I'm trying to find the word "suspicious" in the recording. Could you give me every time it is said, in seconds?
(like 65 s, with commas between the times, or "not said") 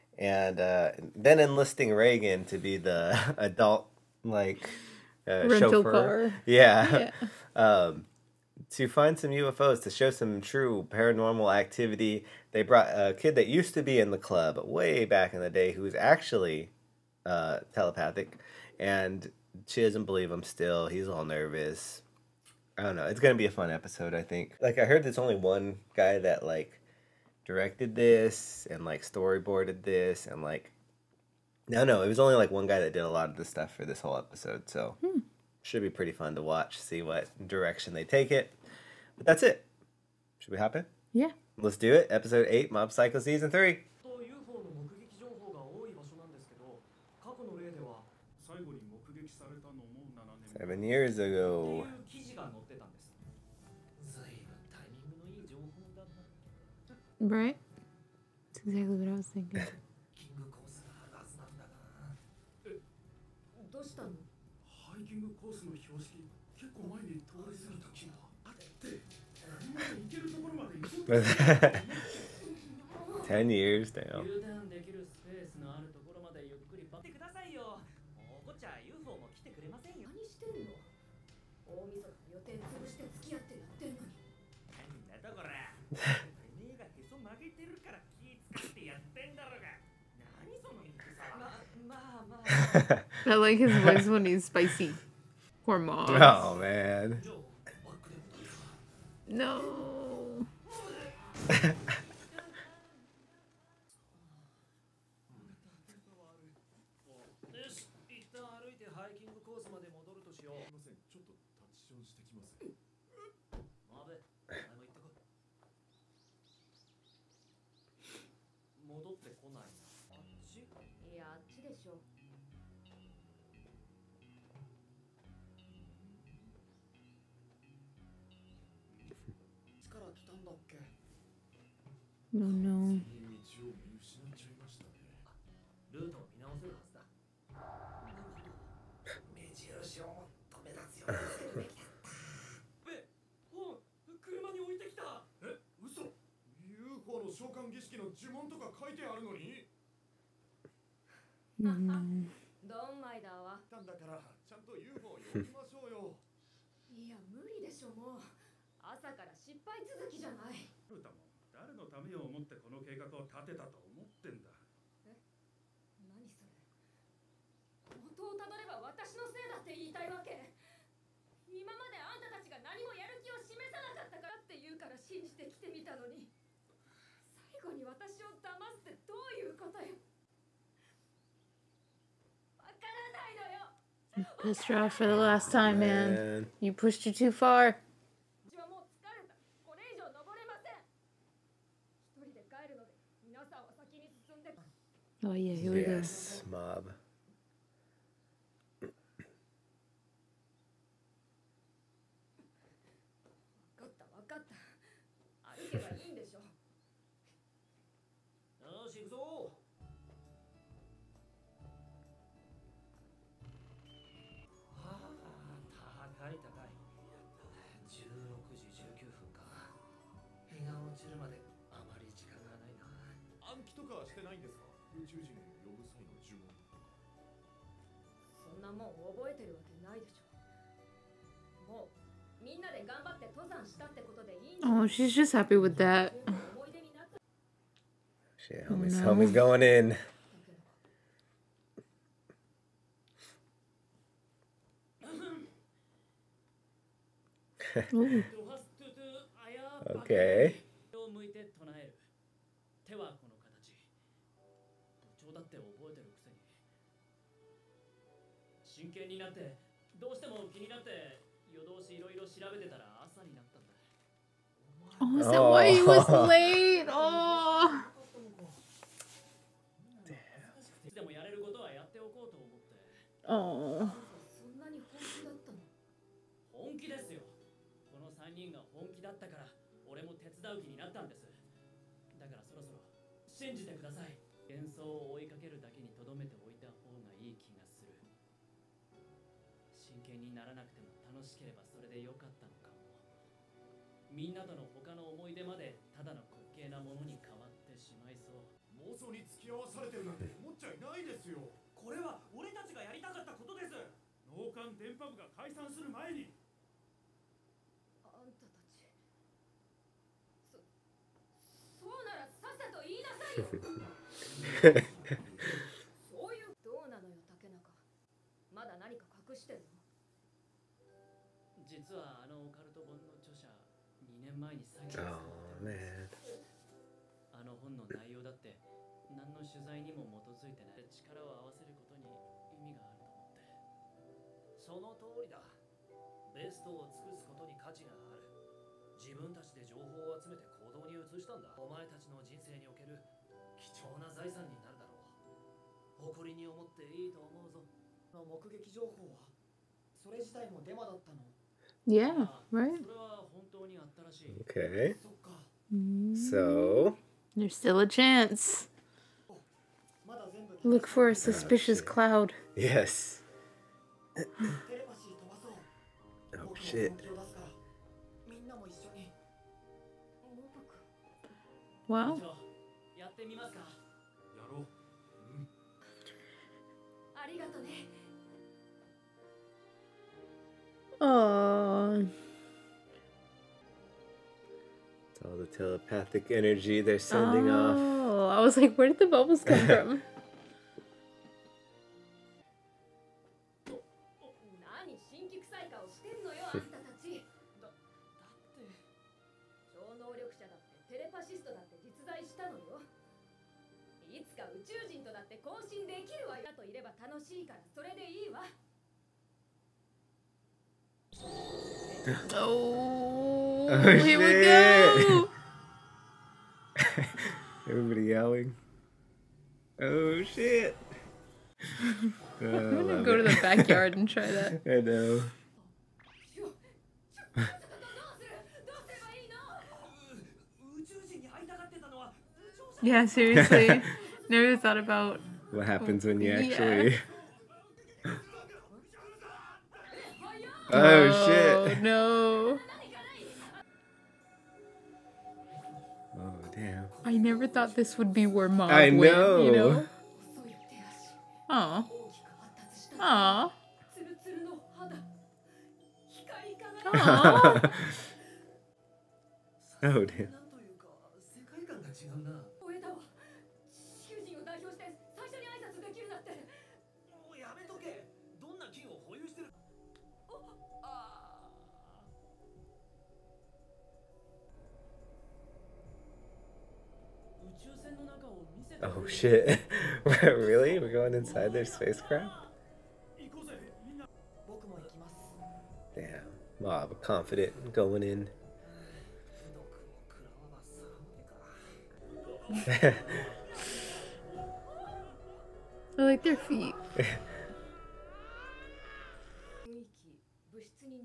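361 s.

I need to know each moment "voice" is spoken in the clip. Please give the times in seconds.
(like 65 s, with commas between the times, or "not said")
93 s.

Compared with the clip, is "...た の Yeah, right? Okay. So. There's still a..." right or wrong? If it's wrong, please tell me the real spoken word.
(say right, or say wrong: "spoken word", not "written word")
right.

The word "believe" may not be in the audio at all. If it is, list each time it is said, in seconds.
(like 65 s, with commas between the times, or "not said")
20 s.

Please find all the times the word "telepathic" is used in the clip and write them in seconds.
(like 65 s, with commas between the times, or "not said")
17 s, 385 s.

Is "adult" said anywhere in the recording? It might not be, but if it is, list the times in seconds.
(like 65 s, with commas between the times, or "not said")
3 s.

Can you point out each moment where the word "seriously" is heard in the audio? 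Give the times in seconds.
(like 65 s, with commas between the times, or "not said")
433 s.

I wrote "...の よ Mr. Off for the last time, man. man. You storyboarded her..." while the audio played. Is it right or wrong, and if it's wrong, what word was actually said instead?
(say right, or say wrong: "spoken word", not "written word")
wrong: "pushed", not "storyboarded".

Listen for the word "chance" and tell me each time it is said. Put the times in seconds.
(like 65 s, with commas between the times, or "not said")
357 s.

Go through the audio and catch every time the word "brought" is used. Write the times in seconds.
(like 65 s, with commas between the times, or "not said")
12 s.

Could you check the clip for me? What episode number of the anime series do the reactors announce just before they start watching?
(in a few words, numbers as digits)
8.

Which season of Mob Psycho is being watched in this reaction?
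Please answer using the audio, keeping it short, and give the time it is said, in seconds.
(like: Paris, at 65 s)
Season 3, at 43 s.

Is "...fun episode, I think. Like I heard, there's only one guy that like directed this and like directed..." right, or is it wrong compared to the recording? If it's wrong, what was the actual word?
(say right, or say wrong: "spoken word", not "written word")
wrong: "storyboarded", not "directed".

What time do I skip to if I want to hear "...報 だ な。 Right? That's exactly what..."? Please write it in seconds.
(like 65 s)
55 s.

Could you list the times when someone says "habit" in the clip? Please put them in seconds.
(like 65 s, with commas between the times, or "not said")
not said.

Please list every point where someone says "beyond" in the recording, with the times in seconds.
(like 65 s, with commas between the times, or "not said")
not said.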